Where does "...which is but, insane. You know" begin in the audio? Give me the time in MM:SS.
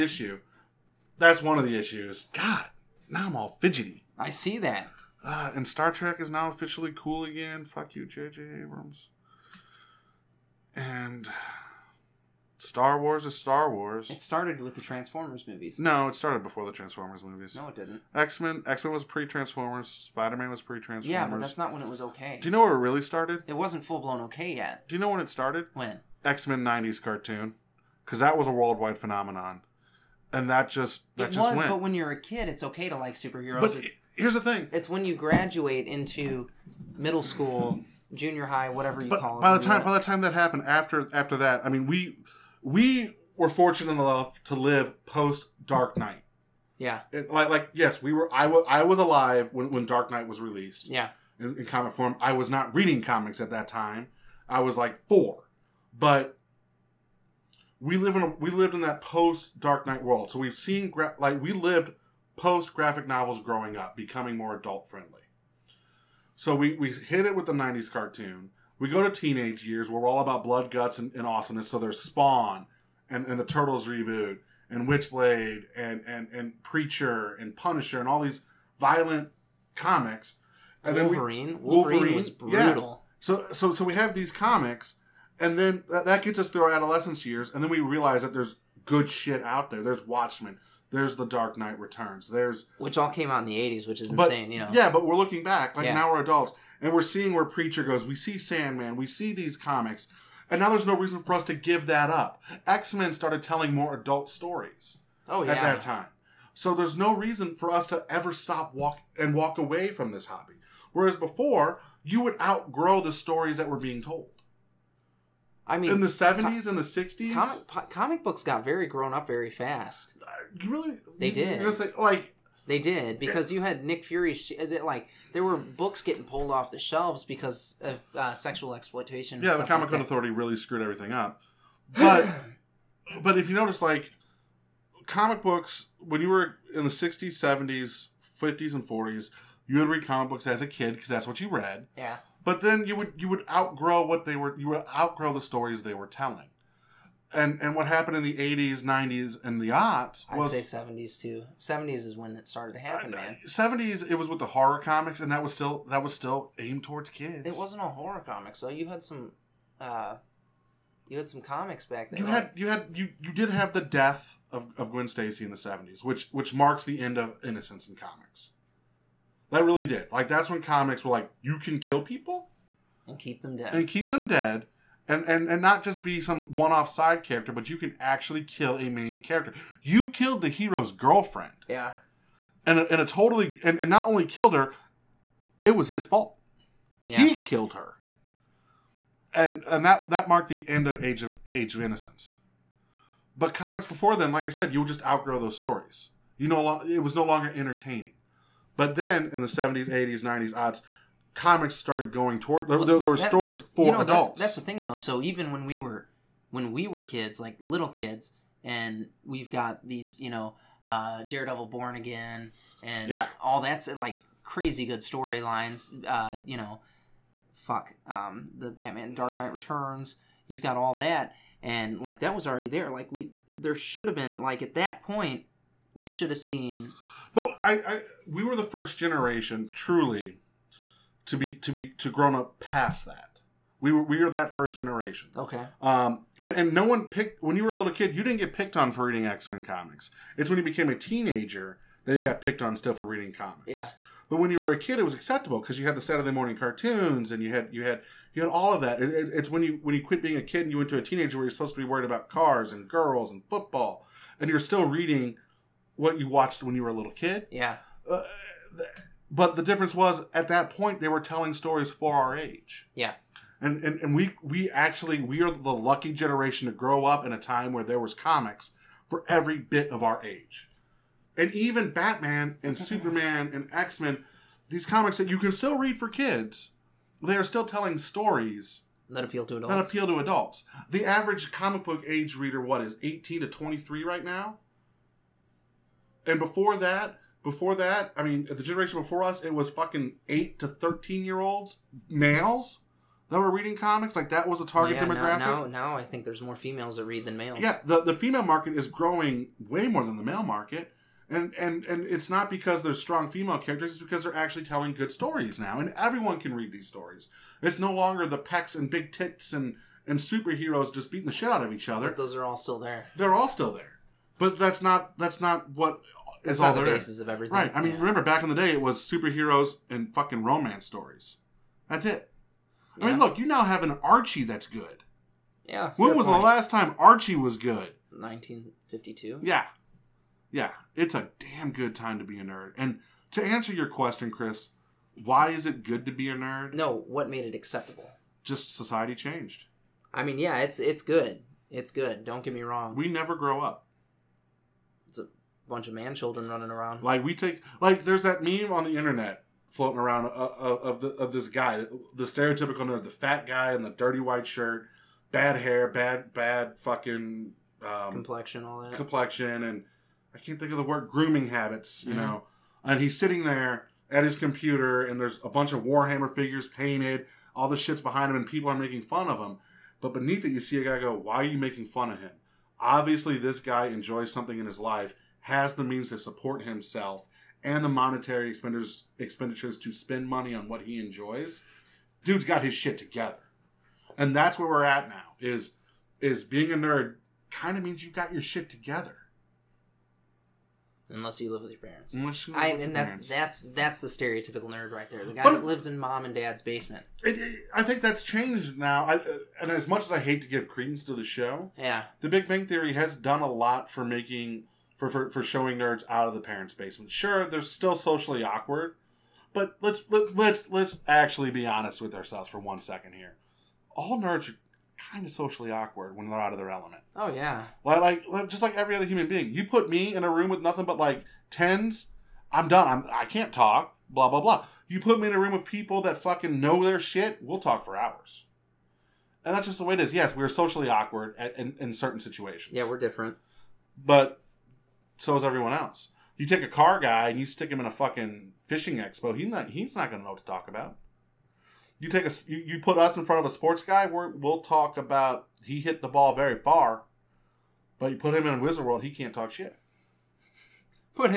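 01:33.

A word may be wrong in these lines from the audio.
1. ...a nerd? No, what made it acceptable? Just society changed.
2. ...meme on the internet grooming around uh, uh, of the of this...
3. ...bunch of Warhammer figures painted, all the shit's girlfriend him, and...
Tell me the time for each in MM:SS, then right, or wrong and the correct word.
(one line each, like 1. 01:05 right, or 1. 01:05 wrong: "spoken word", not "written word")
1. 05:36 right
2. 05:48 wrong: "floating", not "grooming"
3. 06:05 wrong: "behind", not "girlfriend".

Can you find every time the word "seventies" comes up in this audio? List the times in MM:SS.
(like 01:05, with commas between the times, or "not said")
01:56, 02:17, 02:45.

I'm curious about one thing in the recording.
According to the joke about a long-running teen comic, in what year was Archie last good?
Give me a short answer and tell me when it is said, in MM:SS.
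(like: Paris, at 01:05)
1952, at 05:28.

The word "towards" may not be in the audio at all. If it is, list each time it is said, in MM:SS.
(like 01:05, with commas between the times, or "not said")
02:36, 03:22.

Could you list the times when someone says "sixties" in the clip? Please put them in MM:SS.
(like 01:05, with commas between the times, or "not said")
01:56, 02:16.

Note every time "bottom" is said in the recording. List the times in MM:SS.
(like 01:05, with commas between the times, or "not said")
not said.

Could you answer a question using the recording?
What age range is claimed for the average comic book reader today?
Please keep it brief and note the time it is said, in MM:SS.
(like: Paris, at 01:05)
18 to 23, at 04:43.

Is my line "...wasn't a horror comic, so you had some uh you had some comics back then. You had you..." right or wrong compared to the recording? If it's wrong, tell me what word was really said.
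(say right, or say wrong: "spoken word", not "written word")
right.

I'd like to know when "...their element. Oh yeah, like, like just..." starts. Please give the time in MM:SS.
06:56.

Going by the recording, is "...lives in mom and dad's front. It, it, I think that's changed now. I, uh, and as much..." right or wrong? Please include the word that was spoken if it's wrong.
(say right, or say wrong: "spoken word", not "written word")
wrong: "basement", not "front".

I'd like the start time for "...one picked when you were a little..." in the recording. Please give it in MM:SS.
03:56.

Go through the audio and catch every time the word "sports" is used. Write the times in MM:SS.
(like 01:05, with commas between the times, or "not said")
07:23.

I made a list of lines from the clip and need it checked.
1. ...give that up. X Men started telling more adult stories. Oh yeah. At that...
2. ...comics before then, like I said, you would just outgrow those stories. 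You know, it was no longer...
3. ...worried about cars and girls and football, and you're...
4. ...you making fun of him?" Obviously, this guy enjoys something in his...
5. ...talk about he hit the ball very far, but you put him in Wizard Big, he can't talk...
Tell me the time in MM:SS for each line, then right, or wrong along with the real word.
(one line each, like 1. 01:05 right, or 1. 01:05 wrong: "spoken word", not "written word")
1. 01:41 right
2. 03:13 right
3. 04:11 right
4. 06:11 right
5. 07:24 wrong: "World", not "Big".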